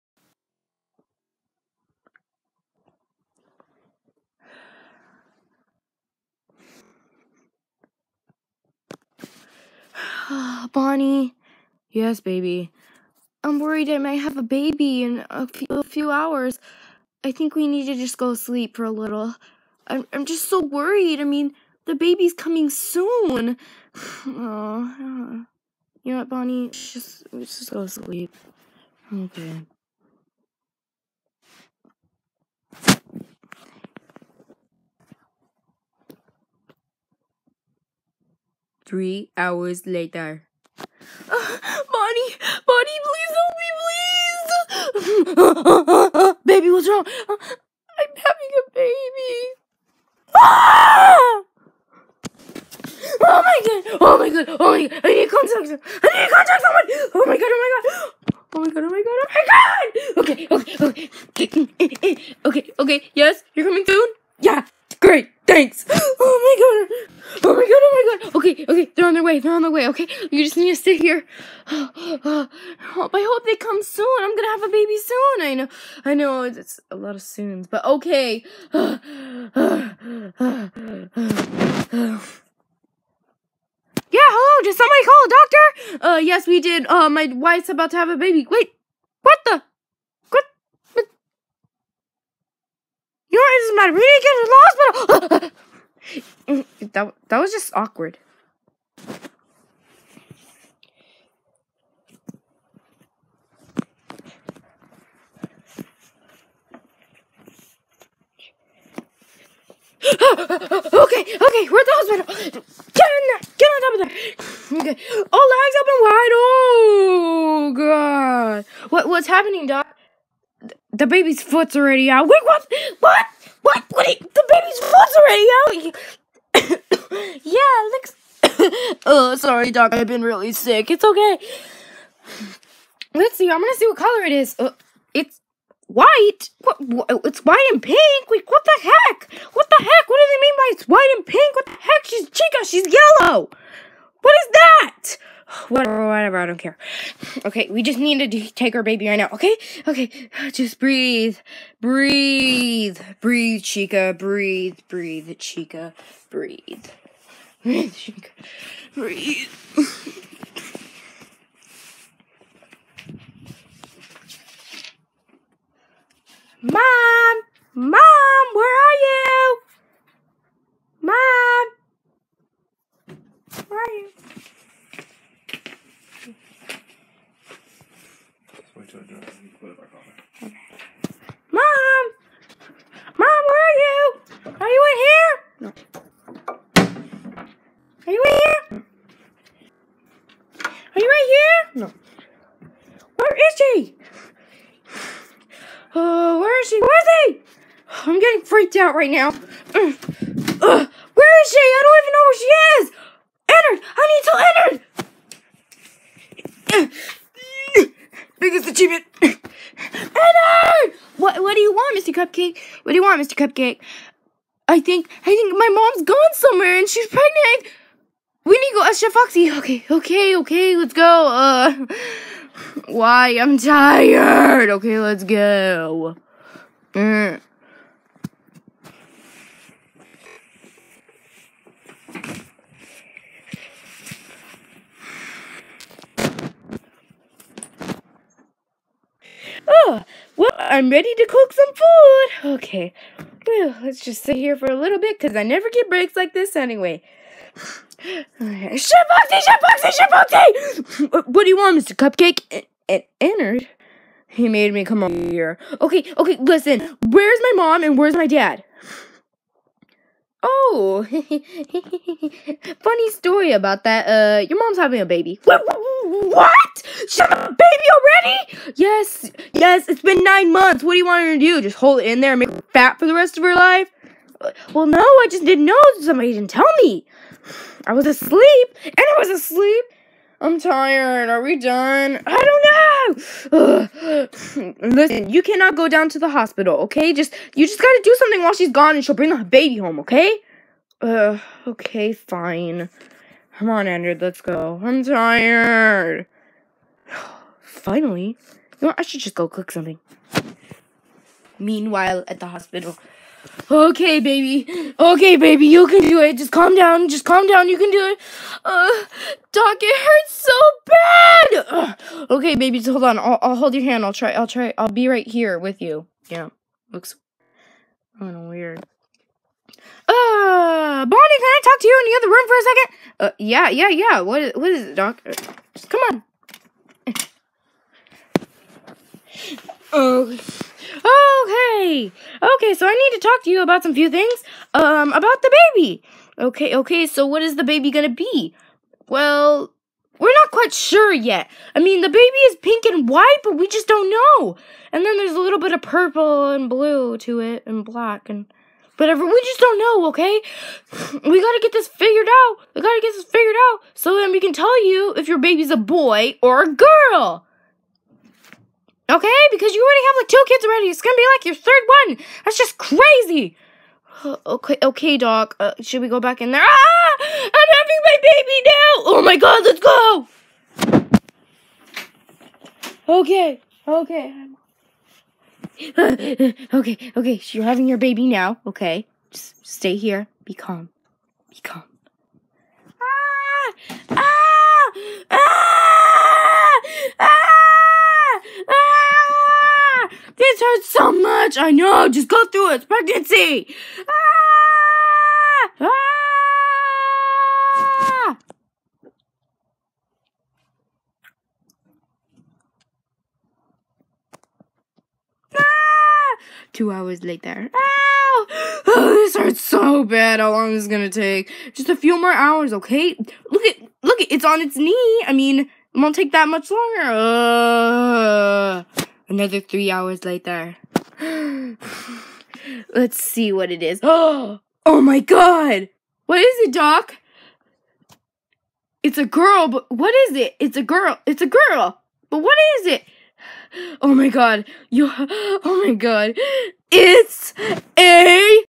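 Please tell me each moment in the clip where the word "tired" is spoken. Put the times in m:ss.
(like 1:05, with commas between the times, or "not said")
3:43, 4:40, 4:55.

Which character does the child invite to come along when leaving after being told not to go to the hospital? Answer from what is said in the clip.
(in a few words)
Andrew.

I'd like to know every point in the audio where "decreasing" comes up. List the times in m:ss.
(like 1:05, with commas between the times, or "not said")
not said.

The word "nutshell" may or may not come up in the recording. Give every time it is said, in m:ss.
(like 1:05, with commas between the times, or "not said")
not said.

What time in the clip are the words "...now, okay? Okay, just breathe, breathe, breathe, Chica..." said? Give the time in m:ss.
2:29.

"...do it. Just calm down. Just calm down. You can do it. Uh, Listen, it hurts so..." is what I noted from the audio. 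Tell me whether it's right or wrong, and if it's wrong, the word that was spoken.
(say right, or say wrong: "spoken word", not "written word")
wrong: "Doc", not "Listen".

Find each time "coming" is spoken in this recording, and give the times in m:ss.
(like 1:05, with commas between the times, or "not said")
0:22, 1:03.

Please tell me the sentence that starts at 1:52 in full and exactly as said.
Get in there, get on top of there.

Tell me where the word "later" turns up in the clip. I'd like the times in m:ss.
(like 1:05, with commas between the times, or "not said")
0:39, 6:47, 7:00.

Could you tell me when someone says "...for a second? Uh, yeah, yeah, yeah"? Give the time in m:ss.
5:22.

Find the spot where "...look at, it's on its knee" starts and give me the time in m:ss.
6:54.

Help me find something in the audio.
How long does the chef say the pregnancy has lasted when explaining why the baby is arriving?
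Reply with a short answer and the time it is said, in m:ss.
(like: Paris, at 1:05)
9 months, at 4:30.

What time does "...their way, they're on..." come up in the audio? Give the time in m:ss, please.
1:09.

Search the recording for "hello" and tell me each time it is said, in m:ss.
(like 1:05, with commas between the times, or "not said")
1:24.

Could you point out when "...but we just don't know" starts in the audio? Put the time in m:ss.
5:43.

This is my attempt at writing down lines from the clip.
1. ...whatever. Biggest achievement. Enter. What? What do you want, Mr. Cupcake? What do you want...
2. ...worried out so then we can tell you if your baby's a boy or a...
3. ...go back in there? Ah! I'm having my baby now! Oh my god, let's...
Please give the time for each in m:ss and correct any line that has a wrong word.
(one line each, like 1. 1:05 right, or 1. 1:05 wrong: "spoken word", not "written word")
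1. 3:26 wrong: "enter", not "whatever"
2. 5:53 wrong: "figured", not "worried"
3. 6:06 right.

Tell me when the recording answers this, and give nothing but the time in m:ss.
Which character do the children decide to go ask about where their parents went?
3:38.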